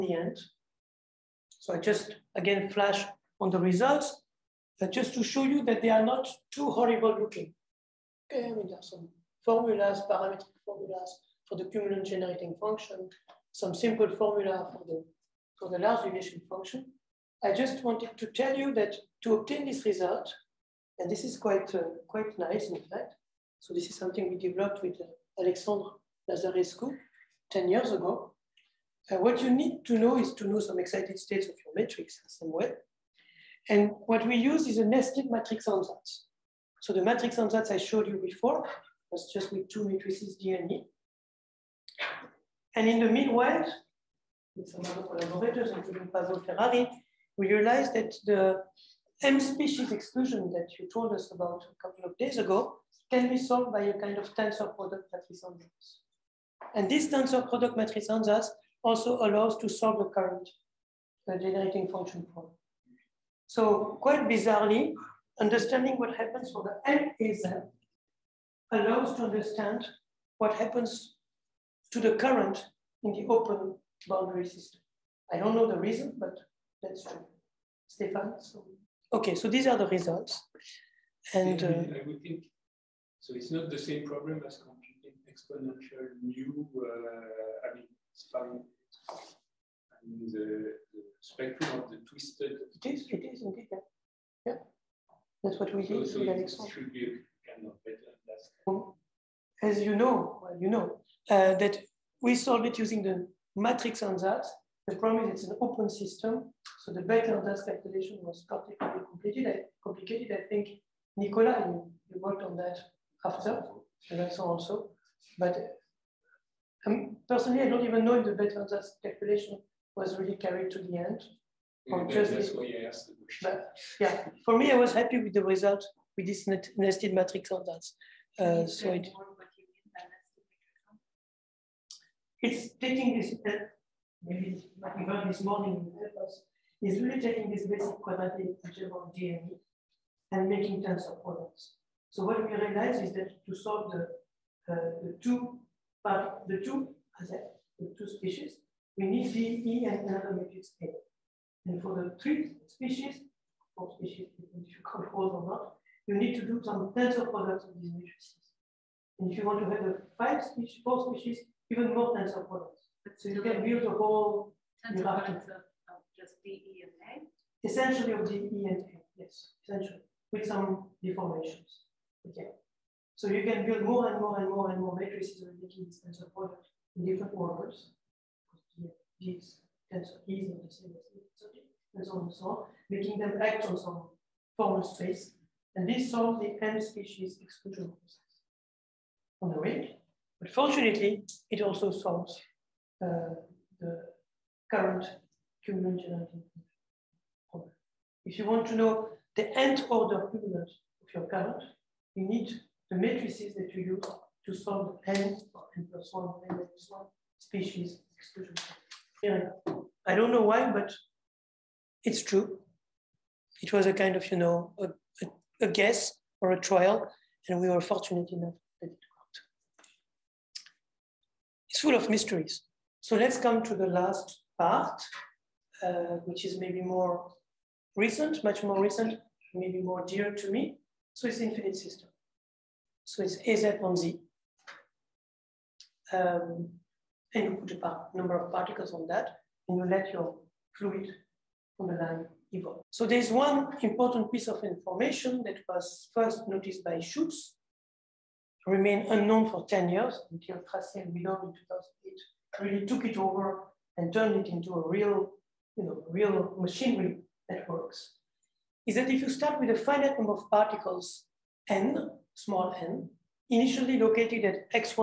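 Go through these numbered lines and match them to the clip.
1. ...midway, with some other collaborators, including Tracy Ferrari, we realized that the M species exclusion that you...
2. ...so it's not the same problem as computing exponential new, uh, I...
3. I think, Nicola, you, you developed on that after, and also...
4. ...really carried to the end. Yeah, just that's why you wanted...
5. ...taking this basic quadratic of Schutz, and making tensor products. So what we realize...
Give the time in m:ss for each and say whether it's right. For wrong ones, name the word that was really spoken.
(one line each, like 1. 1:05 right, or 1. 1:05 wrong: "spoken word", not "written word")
1. 0:43 wrong: "Pablo", not "Tracy"
2. 1:23 right
3. 1:50 wrong: "worked", not "developed"
4. 2:00 wrong: "asked", not "wanted"
5. 2:17 wrong: "DNA", not "Schutz".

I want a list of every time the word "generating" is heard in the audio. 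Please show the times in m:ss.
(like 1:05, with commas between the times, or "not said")
0:12, 1:01, 3:16.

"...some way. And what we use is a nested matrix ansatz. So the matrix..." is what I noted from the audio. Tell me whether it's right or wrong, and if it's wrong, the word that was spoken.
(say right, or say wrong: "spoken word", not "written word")
right.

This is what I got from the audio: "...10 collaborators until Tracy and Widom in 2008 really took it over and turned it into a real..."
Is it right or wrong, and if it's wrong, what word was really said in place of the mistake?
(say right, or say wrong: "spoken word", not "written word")
wrong: "years", not "collaborators".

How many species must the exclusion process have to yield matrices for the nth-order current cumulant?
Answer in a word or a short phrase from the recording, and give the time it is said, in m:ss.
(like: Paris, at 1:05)
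n plus 1, at 3:25.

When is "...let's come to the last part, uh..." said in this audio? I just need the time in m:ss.
3:43.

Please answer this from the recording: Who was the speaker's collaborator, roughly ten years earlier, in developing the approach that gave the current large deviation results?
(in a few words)
Alexandre Lazarescu.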